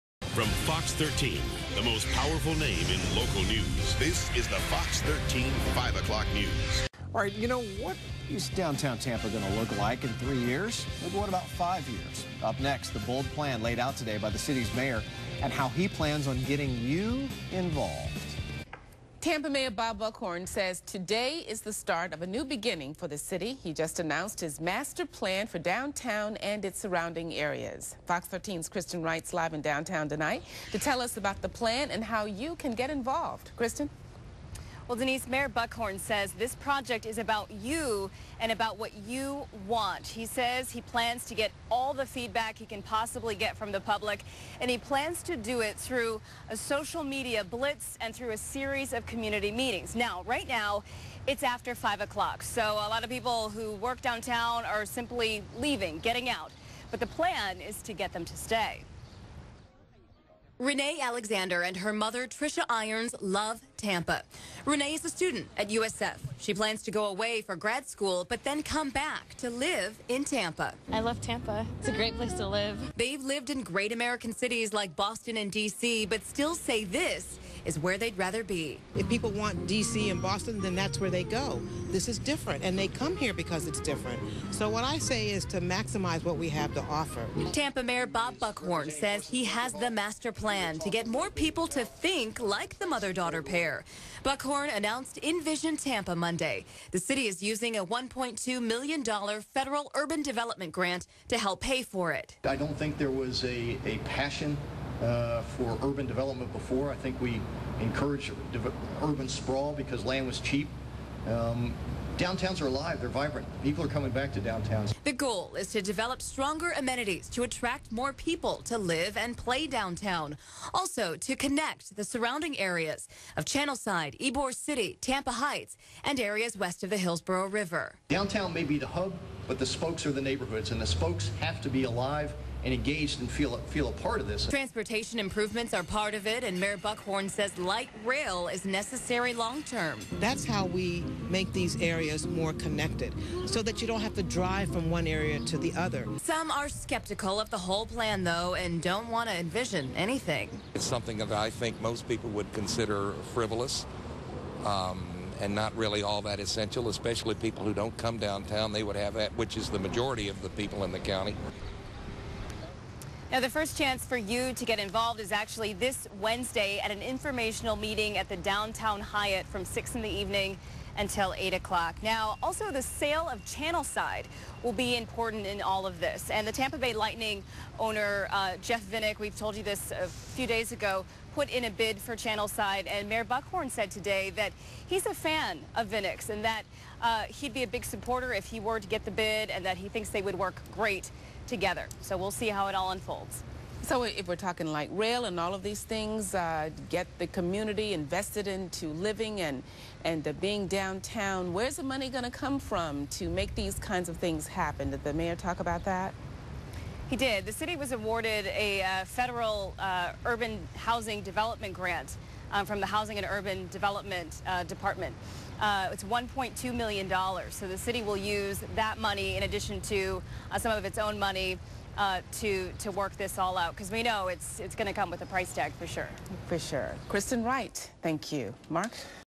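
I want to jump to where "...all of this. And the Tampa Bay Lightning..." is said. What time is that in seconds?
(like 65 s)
175 s.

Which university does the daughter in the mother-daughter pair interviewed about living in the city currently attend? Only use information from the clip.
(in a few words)
USF.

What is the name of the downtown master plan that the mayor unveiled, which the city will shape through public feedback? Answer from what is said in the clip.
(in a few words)
InVision Tampa.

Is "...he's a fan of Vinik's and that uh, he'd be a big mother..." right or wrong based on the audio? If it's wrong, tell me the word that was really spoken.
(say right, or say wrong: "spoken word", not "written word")
wrong: "supporter", not "mother".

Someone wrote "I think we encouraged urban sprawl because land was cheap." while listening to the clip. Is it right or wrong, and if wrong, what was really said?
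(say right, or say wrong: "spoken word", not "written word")
right.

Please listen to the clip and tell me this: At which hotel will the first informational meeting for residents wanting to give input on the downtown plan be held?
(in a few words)
the downtown Hyatt.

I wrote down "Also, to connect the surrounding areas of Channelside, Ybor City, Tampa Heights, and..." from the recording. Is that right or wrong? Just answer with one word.
right.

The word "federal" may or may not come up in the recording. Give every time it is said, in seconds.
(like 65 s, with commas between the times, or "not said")
99 s, 209 s.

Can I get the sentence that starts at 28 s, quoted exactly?
Fox 13's Kristen Wright's live in downtown tonight to tell us about the plan and how you can get involved.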